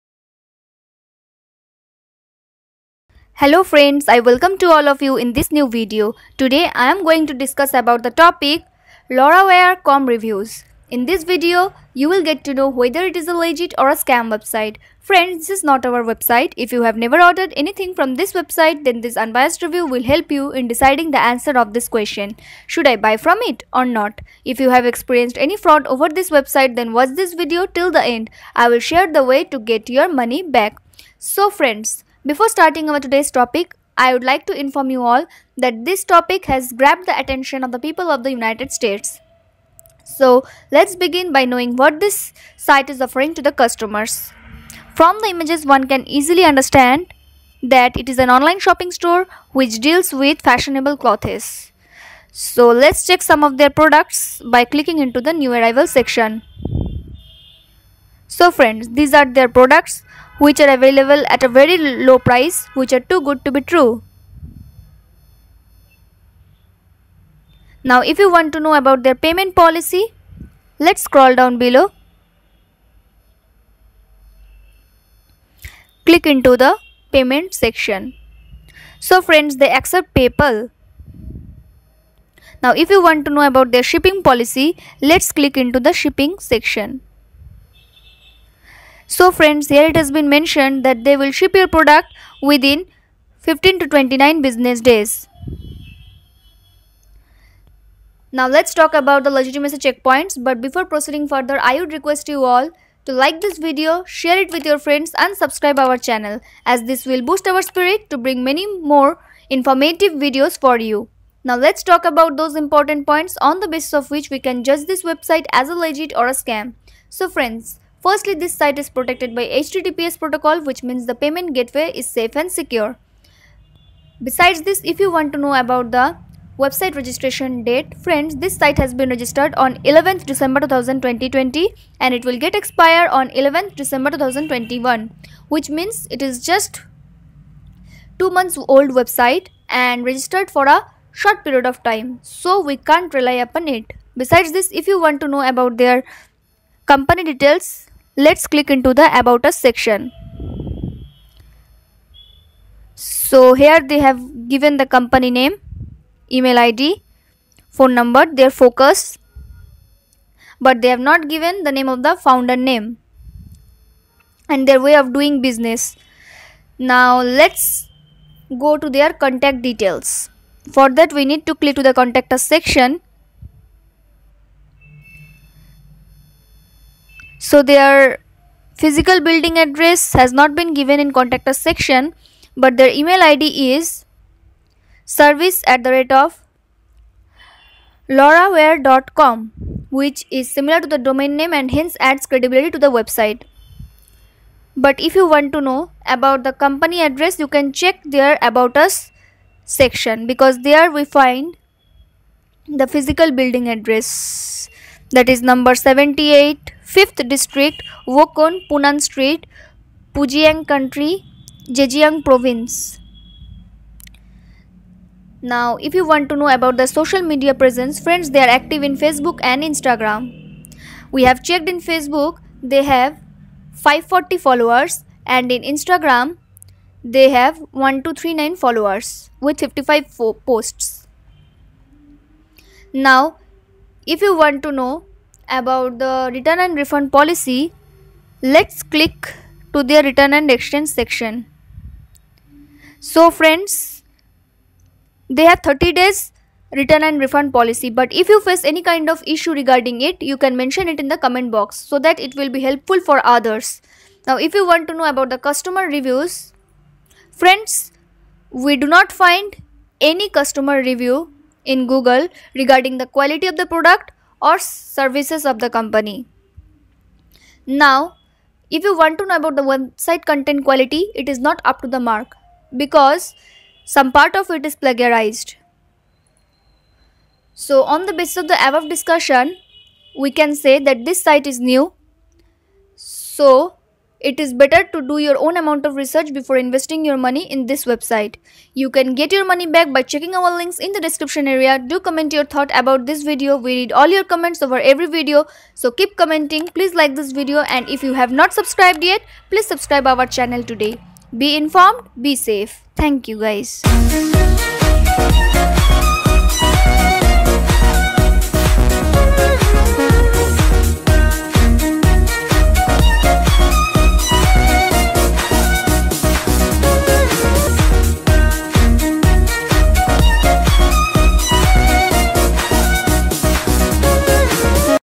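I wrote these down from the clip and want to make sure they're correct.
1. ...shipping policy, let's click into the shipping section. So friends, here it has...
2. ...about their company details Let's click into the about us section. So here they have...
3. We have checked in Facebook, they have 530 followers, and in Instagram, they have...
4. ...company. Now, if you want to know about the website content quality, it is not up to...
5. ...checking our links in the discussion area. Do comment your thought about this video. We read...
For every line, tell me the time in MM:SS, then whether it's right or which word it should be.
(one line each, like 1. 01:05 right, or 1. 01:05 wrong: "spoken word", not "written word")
1. 01:23 right
2. 02:25 right
3. 03:41 wrong: "540", not "530"
4. 04:25 right
5. 04:50 wrong: "description", not "discussion".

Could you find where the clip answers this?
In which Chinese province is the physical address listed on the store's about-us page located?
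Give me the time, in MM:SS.
03:31.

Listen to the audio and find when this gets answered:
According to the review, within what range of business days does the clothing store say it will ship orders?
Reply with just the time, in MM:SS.
01:33.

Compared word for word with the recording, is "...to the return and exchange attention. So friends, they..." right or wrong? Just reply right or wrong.
wrong.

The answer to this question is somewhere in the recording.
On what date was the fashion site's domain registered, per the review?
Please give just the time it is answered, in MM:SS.
02:09.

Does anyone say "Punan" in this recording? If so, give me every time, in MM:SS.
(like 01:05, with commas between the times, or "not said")
03:28.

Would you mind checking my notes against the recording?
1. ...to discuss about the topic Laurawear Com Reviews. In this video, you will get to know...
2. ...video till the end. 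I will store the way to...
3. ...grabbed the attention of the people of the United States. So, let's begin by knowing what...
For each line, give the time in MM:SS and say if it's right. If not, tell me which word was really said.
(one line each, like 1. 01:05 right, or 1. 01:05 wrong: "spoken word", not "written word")
1. 00:07 right
2. 00:27 wrong: "share", not "store"
3. 00:36 right.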